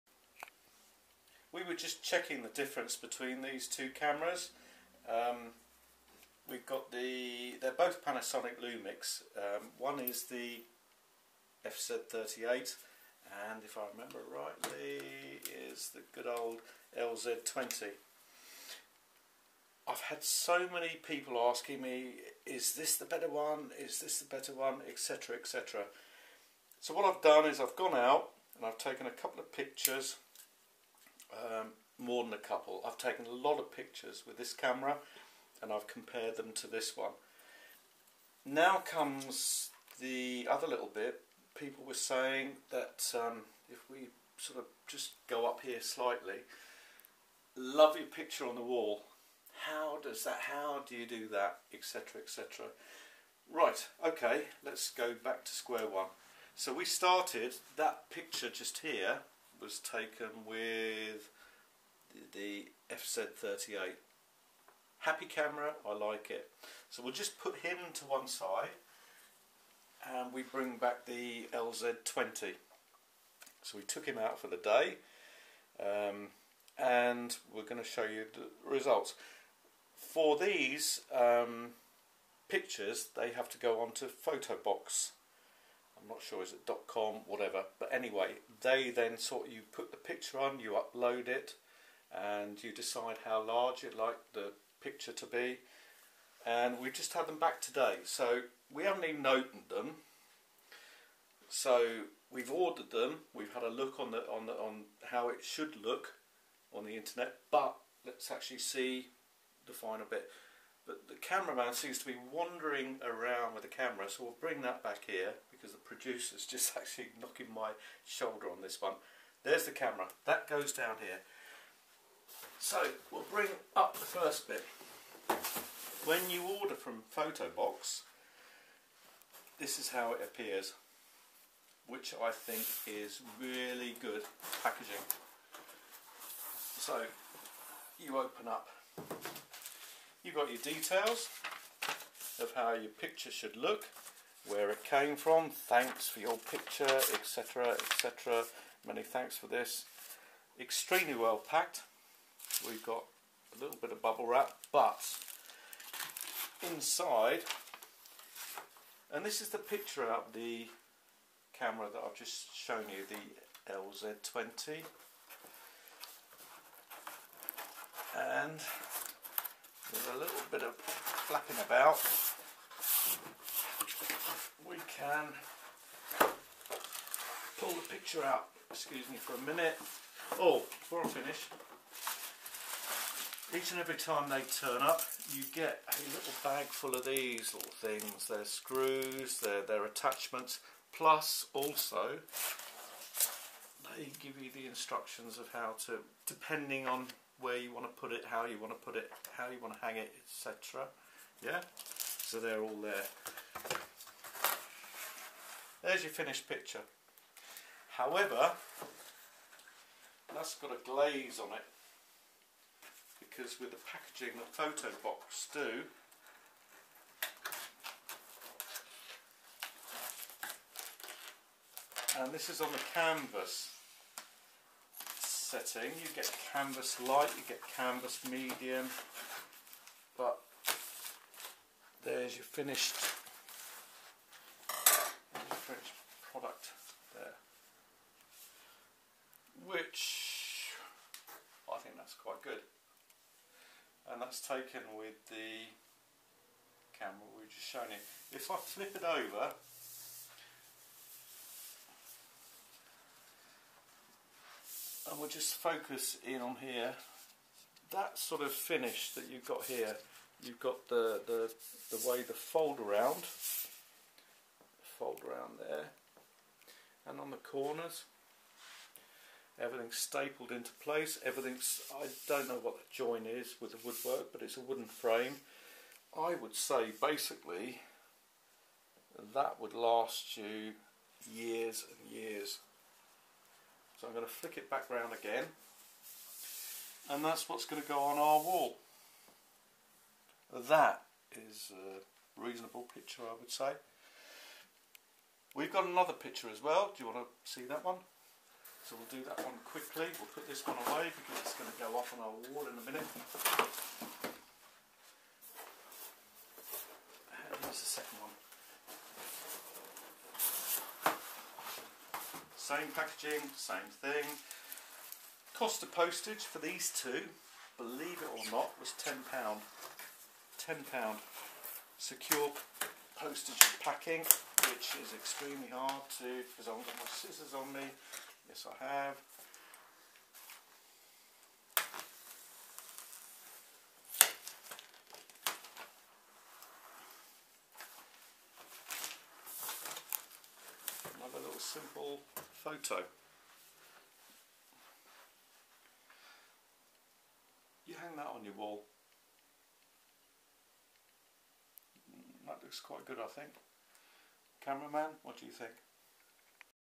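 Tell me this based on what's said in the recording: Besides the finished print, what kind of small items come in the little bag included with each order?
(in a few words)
screws.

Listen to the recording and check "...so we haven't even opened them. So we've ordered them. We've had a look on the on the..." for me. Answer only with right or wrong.
right.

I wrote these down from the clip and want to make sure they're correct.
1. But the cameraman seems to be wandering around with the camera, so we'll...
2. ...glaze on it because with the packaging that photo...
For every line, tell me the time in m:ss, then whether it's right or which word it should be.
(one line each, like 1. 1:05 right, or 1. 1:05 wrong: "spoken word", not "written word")
1. 1:50 right
2. 3:30 right.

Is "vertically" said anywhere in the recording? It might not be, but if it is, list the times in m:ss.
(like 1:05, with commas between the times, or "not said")
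not said.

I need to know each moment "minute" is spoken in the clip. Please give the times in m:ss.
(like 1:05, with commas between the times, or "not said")
2:59, 5:02.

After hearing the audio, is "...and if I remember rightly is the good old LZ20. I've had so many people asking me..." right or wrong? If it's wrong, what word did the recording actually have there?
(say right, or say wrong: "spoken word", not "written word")
right.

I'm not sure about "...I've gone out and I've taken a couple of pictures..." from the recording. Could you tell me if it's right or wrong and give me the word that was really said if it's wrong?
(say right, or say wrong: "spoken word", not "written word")
right.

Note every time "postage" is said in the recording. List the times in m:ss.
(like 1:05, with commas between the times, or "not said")
5:15, 5:23.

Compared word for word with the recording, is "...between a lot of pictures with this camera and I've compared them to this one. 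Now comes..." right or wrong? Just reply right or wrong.
wrong.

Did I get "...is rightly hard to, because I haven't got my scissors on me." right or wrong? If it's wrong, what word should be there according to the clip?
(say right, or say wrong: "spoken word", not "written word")
wrong: "extremely", not "rightly".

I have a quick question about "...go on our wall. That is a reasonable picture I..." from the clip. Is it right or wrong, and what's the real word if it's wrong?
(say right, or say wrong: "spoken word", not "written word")
right.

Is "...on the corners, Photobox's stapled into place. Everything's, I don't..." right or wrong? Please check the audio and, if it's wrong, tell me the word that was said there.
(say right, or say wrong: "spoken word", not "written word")
wrong: "Everything", not "Photobox".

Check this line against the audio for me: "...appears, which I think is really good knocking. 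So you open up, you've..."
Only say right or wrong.
wrong.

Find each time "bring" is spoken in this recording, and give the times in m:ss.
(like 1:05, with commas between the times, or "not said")
1:10, 1:54, 2:03.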